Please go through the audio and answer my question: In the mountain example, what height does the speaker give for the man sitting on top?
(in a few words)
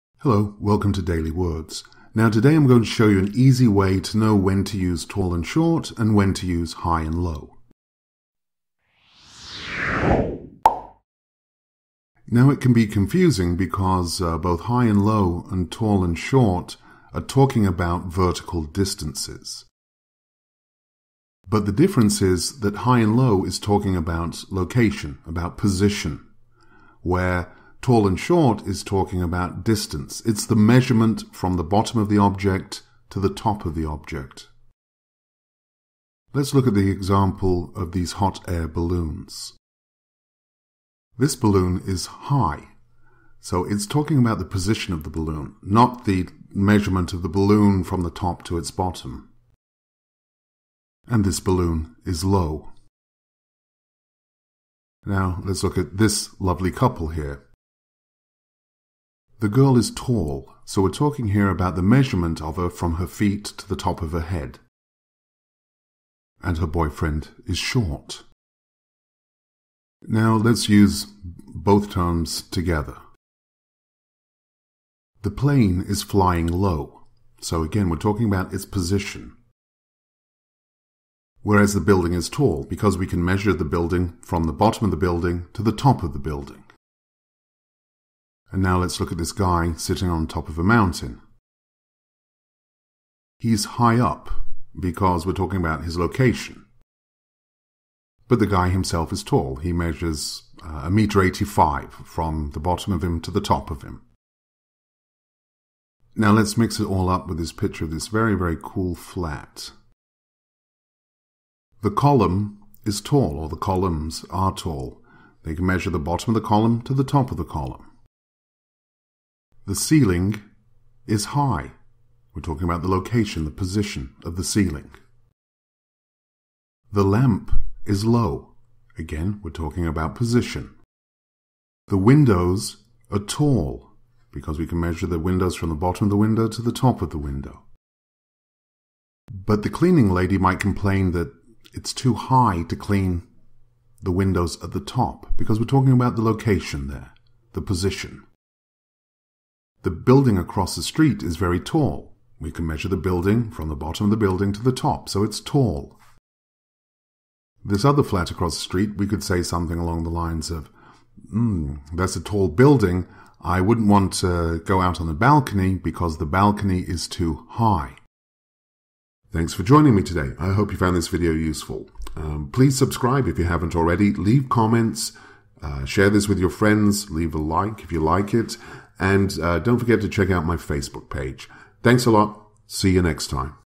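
1.85 meters.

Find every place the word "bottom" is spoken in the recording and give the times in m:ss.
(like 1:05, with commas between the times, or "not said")
0:31, 0:48, 1:24, 1:42, 1:55, 2:15, 2:33.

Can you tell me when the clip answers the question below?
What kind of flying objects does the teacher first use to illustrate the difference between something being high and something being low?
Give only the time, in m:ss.
0:38.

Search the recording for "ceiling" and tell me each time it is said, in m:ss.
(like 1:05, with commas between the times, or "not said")
1:59, 2:04.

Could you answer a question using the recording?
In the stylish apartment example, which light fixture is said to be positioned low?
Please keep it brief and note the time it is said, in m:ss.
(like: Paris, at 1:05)
the lamp, at 2:06.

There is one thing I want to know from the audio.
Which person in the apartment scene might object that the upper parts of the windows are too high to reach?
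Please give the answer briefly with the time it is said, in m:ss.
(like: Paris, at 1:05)
the cleaning lady, at 2:19.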